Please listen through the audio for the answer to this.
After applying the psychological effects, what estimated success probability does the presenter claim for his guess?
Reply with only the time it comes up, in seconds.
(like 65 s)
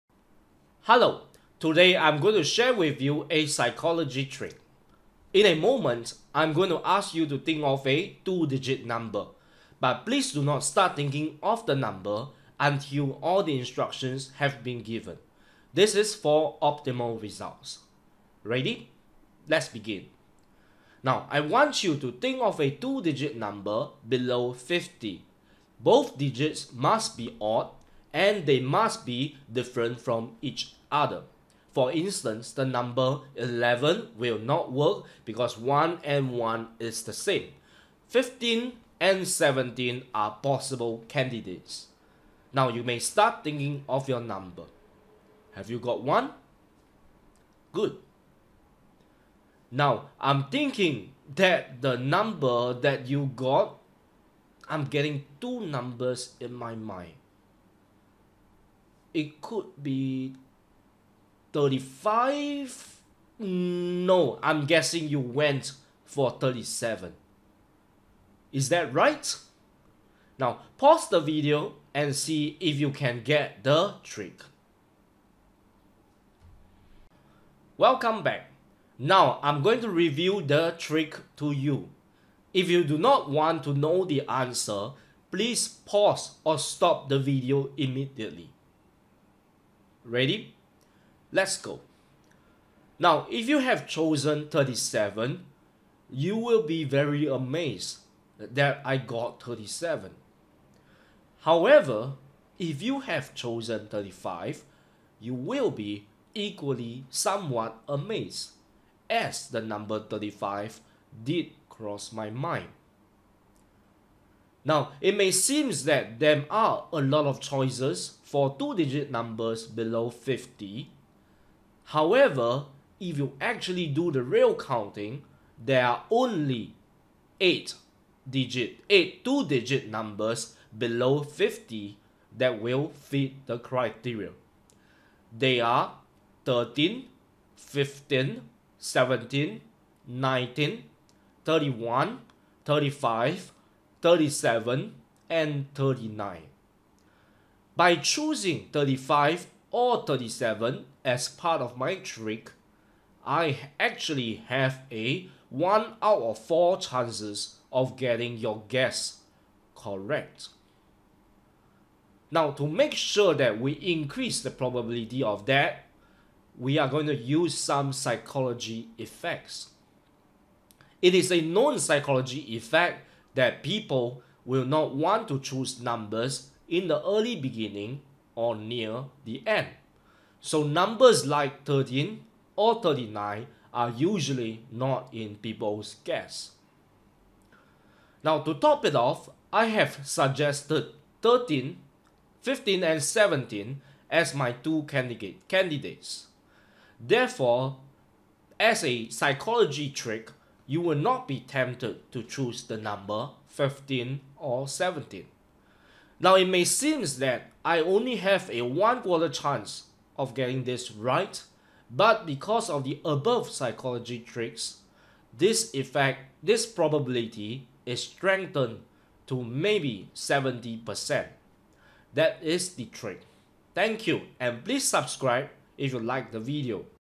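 220 s.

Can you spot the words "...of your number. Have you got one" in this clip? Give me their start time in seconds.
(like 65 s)
43 s.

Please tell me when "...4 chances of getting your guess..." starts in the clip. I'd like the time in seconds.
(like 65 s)
156 s.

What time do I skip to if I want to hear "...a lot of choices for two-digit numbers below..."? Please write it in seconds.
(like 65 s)
116 s.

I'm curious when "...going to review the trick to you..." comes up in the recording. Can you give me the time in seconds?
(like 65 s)
79 s.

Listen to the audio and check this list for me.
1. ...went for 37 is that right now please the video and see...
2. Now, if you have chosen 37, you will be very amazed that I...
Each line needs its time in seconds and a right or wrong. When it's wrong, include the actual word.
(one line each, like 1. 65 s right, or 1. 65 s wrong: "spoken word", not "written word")
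1. 65 s wrong: "pause", not "please"
2. 92 s right.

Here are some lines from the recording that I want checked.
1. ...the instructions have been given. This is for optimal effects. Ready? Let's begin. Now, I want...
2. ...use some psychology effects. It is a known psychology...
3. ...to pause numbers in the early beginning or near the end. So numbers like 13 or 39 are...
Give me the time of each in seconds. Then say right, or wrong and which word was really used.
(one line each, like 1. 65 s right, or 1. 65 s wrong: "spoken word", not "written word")
1. 13 s wrong: "results", not "effects"
2. 167 s right
3. 175 s wrong: "choose", not "pause".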